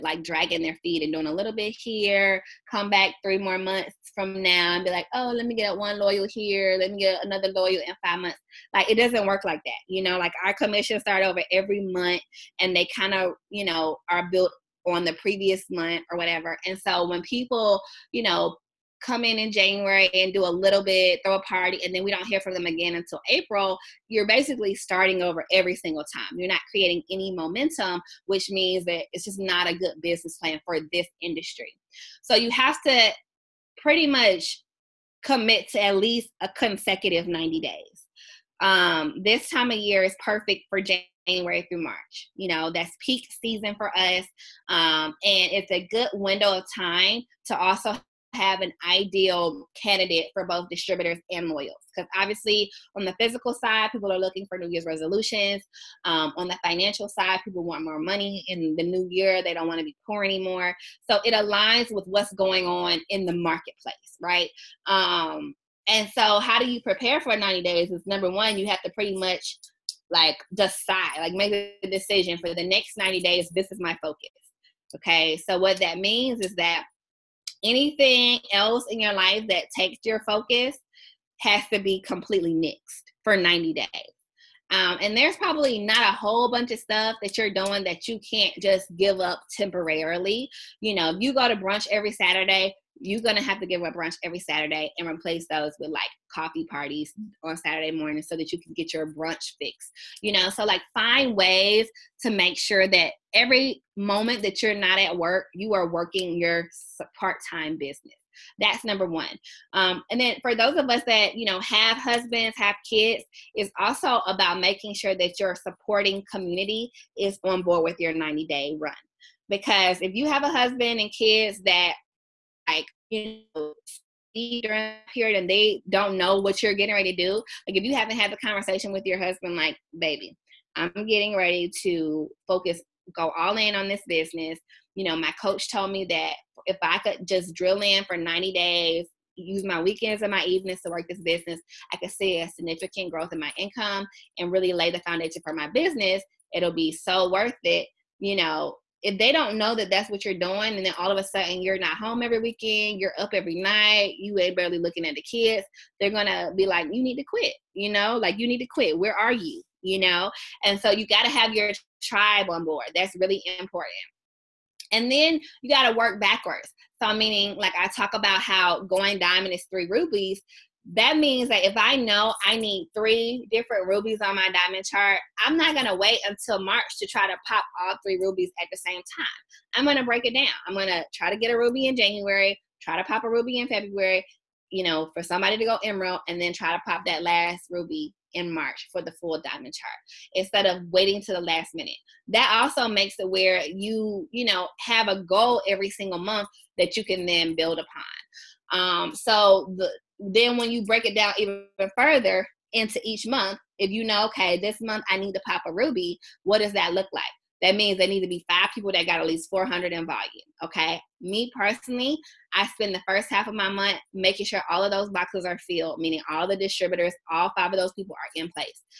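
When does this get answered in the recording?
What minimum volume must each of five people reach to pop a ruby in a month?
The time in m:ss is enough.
3:29.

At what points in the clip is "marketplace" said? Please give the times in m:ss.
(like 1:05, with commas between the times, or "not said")
1:03.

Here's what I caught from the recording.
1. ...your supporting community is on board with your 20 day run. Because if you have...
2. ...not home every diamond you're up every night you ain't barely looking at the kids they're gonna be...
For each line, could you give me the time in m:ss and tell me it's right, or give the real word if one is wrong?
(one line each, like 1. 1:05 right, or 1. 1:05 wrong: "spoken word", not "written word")
1. 1:55 wrong: "90", not "20"
2. 2:31 wrong: "weekend", not "diamond".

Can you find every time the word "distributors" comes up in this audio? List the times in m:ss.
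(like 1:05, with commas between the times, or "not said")
0:50, 3:36.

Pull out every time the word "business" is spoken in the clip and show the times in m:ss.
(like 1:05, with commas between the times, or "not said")
0:30, 1:47, 2:14, 2:21, 2:25.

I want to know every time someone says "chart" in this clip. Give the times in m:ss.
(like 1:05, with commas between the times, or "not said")
2:54, 3:09.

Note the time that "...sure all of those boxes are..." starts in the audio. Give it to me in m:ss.
3:34.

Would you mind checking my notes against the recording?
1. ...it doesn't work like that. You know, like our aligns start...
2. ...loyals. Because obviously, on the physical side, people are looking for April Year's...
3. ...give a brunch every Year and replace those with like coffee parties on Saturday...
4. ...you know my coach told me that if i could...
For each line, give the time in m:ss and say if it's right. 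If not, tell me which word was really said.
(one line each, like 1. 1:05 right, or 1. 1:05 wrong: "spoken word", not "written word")
1. 0:08 wrong: "commissions", not "aligns"
2. 0:51 wrong: "New", not "April"
3. 1:33 wrong: "Saturday", not "Year"
4. 2:14 right.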